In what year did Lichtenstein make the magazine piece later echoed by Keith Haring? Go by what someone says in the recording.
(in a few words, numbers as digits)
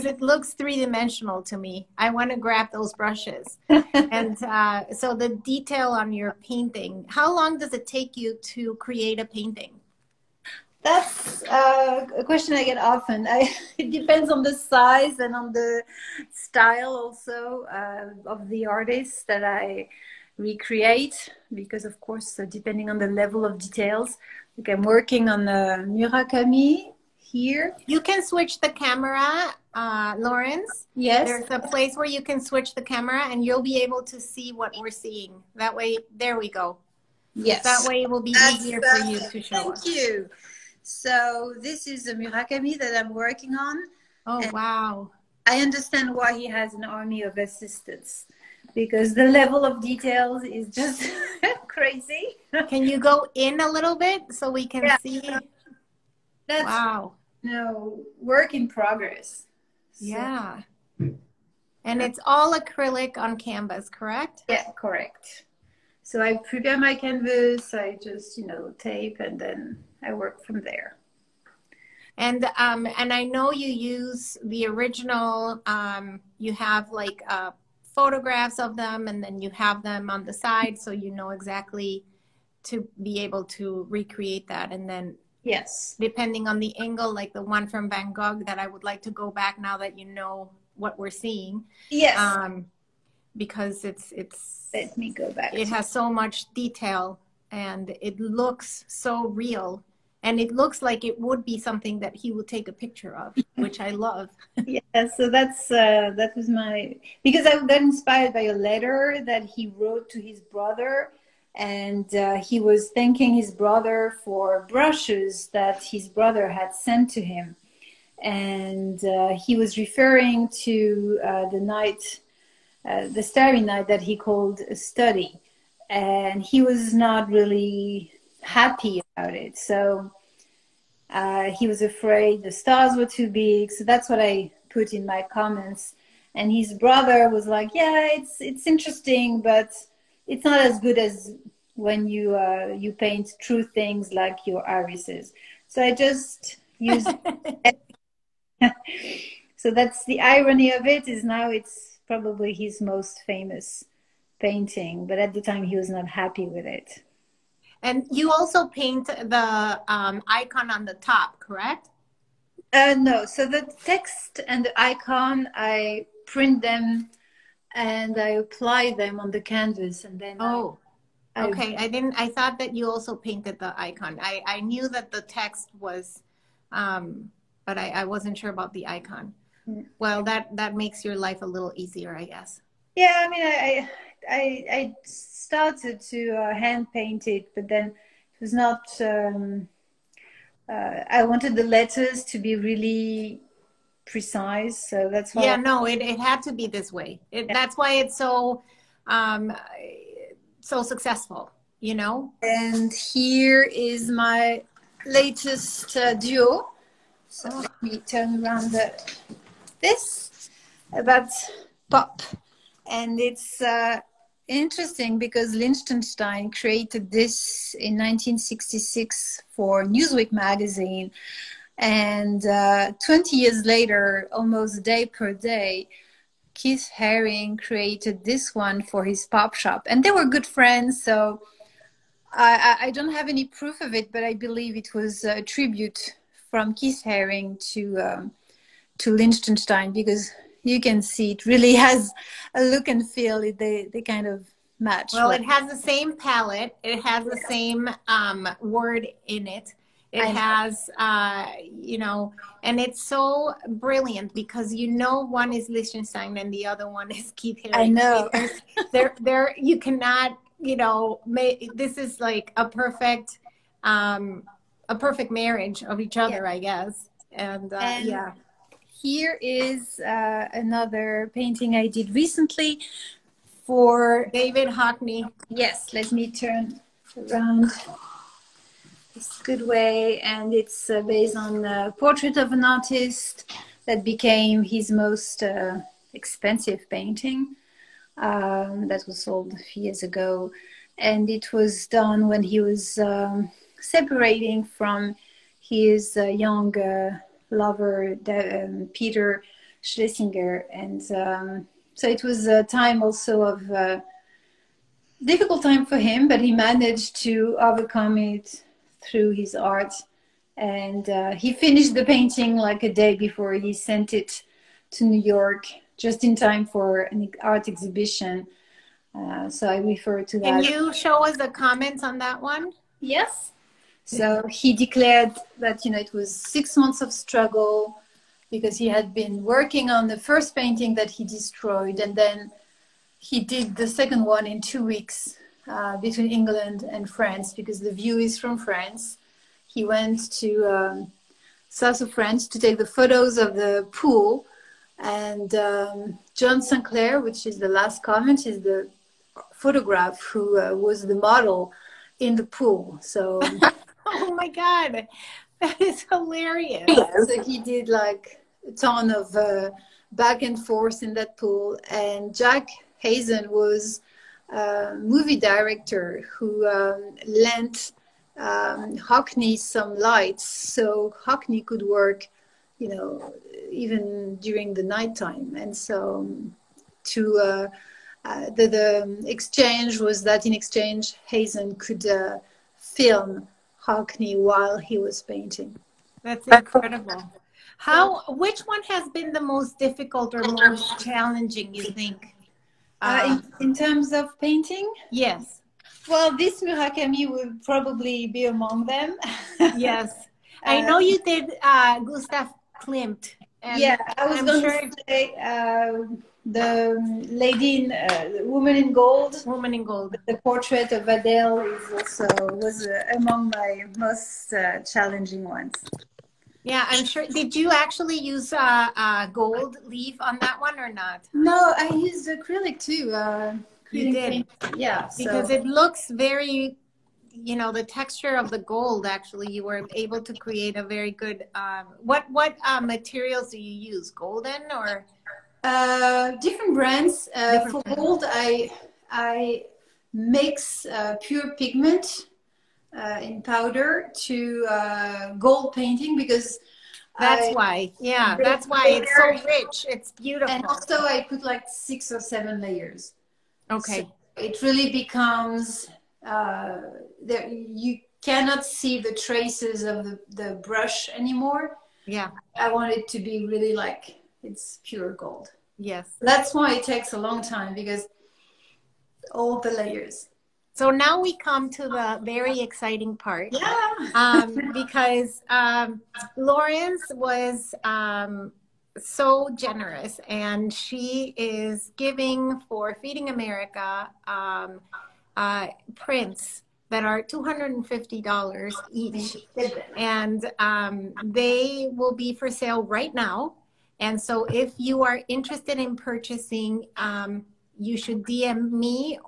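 1966.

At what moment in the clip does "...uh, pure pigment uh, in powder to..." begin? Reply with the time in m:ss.
7:20.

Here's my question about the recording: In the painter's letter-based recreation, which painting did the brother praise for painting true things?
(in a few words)
Irises.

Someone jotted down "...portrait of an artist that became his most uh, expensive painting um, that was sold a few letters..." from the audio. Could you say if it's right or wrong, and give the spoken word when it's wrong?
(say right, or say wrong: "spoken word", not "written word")
wrong: "years", not "letters".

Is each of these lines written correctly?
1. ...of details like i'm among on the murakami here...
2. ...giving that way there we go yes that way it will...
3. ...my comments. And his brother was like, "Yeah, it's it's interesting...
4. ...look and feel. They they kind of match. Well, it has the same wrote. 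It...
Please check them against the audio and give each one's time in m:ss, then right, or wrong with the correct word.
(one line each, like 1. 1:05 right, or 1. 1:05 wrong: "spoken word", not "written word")
1. 0:23 wrong: "working", not "among"
2. 0:34 wrong: "seeing", not "giving"
3. 2:15 right
4. 4:02 wrong: "palette", not "wrote".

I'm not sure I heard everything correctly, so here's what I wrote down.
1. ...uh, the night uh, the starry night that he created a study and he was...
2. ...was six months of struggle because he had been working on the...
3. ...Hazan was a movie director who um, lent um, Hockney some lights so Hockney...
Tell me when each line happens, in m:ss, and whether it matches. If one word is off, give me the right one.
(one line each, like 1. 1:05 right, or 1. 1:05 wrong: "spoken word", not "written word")
1. 2:01 wrong: "called", not "created"
2. 5:26 right
3. 6:03 right.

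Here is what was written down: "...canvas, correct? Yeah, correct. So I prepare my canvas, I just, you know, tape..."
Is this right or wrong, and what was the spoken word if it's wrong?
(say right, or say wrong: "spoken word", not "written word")
right.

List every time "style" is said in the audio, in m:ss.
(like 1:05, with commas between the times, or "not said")
0:16.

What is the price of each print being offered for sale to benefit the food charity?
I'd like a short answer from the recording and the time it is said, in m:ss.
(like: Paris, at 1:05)
$250, at 8:07.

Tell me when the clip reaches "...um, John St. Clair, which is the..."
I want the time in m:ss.
5:45.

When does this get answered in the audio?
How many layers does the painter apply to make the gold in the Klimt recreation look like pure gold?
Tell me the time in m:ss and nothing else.
7:31.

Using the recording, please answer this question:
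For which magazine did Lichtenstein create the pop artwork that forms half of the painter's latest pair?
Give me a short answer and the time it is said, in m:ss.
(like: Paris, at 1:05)
Newsweek, at 3:39.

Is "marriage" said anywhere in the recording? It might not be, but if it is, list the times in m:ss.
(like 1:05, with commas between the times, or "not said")
4:25.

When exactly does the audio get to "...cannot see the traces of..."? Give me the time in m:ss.
7:38.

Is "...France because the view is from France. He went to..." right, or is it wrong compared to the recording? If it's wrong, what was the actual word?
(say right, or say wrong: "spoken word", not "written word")
right.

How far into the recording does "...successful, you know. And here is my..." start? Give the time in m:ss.
3:20.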